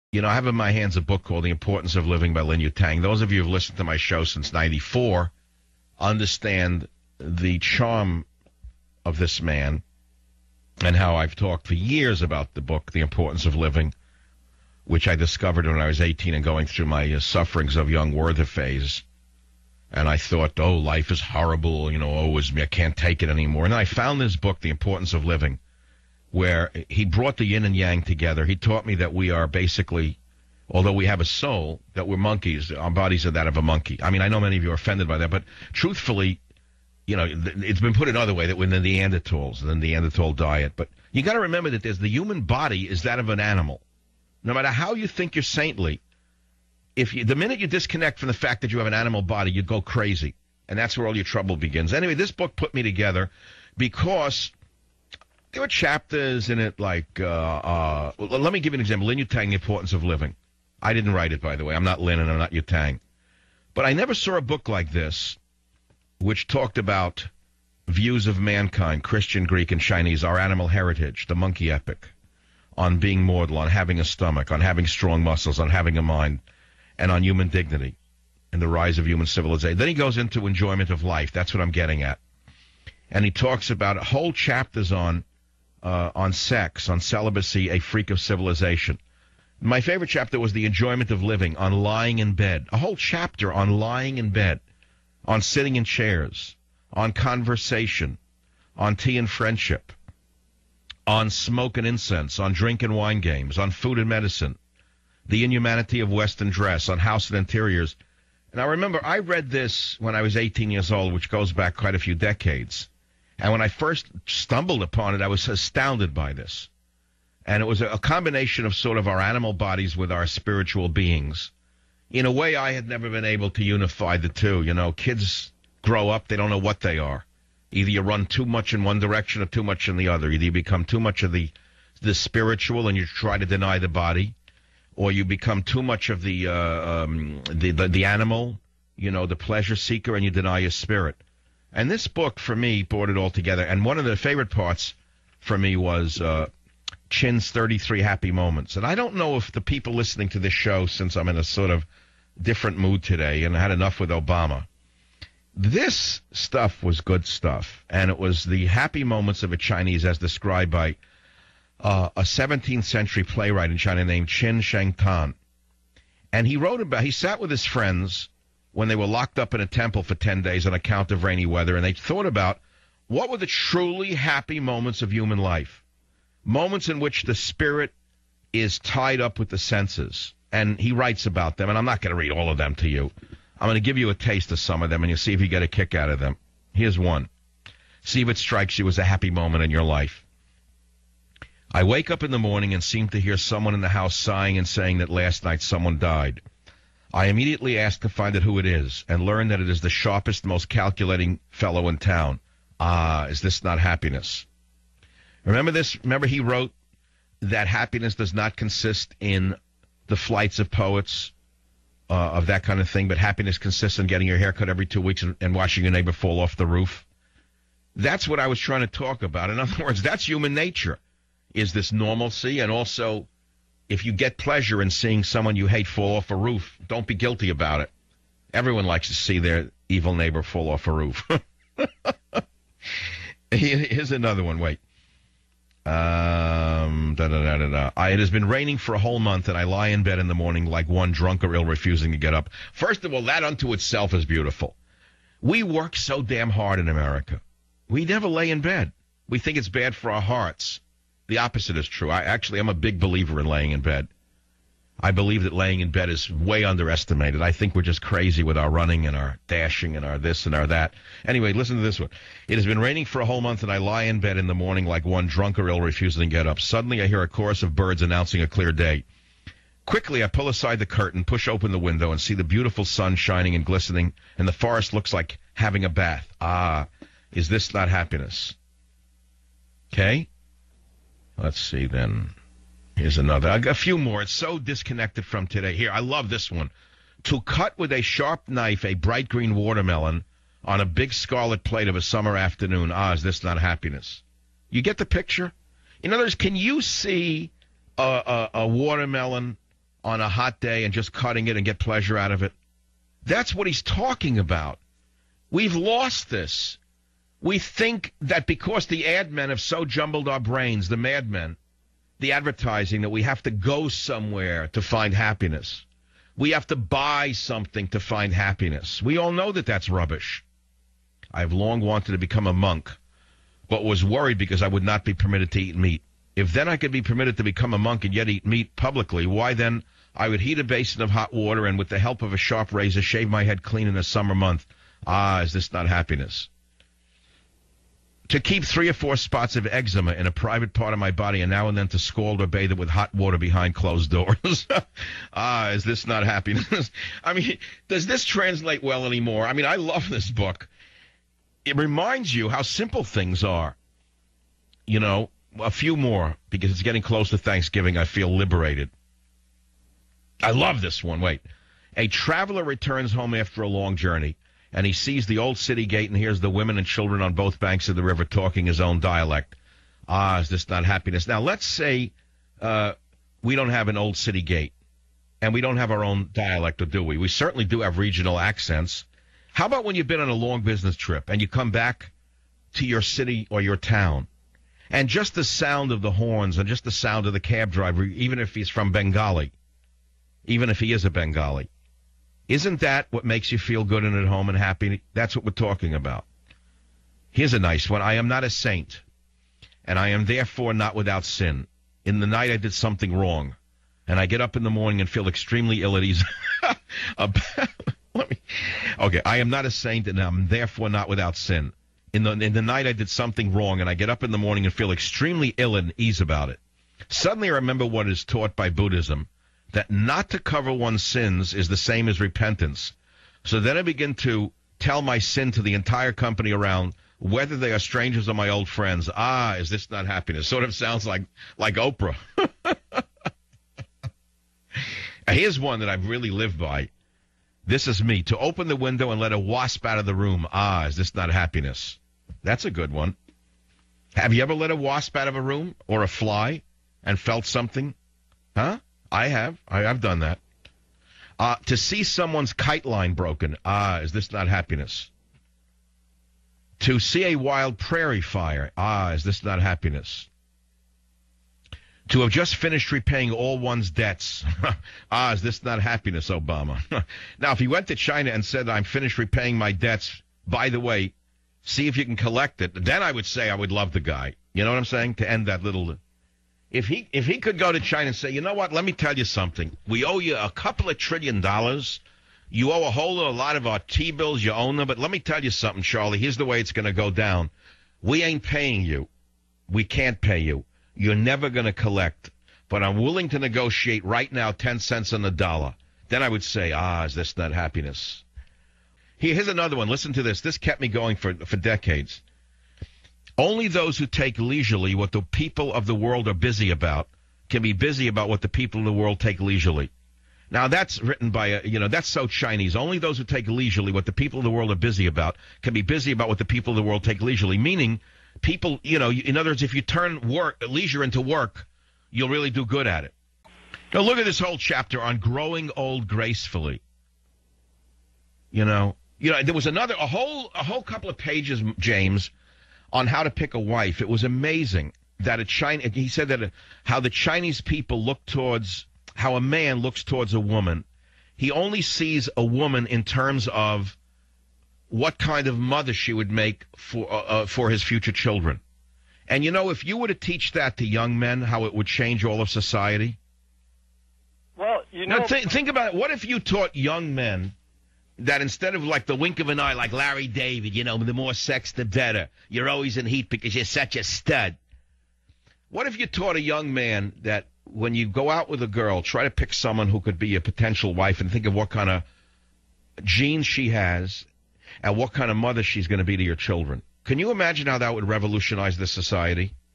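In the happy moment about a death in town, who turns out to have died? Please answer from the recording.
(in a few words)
The sharpest, most calculating fellow.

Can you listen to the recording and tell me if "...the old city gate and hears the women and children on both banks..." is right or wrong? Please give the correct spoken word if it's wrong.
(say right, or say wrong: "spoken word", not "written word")
right.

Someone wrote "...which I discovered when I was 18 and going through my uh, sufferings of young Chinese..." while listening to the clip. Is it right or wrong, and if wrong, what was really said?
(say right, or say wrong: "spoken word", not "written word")
wrong: "Werther", not "Chinese".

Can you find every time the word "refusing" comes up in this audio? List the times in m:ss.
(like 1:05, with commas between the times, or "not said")
4:01, 4:25.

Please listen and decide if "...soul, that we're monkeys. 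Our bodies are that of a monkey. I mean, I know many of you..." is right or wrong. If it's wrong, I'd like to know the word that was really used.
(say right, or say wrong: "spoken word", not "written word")
right.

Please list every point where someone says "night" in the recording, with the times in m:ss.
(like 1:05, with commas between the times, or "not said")
3:15, 6:42, 6:52.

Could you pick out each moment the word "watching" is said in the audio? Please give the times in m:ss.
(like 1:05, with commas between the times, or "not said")
3:35.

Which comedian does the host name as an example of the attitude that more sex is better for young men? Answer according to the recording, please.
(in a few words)
Larry David.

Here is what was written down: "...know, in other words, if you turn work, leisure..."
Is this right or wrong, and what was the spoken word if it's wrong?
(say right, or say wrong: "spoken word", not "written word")
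right.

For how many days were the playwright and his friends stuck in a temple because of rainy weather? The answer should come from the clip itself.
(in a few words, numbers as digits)
10.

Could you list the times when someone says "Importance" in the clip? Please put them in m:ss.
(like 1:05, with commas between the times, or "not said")
0:01, 0:12, 0:24, 0:59.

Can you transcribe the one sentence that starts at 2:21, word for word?
And this book, for me, brought it all together.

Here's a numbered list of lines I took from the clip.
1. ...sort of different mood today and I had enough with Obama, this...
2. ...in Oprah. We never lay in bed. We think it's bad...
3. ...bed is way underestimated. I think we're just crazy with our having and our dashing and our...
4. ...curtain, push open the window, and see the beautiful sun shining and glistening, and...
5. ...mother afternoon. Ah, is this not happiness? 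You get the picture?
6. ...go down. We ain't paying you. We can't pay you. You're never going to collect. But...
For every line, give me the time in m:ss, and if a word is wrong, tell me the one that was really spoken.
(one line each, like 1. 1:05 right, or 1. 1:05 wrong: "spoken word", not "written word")
1. 2:31 right
2. 4:06 wrong: "America", not "Oprah"
3. 4:15 wrong: "running", not "having"
4. 4:30 right
5. 4:52 wrong: "summer", not "mother"
6. 8:06 right.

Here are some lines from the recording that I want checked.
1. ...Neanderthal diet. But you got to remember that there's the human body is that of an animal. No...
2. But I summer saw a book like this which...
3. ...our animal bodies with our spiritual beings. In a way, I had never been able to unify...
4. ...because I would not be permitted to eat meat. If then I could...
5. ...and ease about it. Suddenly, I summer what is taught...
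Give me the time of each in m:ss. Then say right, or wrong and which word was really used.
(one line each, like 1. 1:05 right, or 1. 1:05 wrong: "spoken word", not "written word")
1. 0:39 right
2. 1:03 wrong: "never", not "summer"
3. 1:59 right
4. 5:24 right
5. 6:55 wrong: "remember", not "summer".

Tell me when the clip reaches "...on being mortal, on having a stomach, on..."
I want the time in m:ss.
1:12.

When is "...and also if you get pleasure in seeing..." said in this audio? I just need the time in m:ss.
3:42.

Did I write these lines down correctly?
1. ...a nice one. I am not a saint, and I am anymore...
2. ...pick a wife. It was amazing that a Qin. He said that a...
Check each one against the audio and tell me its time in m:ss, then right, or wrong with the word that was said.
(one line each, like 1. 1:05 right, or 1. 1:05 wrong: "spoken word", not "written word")
1. 6:37 wrong: "therefore", not "anymore"
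2. 8:53 wrong: "China", not "Qin".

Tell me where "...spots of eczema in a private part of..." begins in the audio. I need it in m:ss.
5:39.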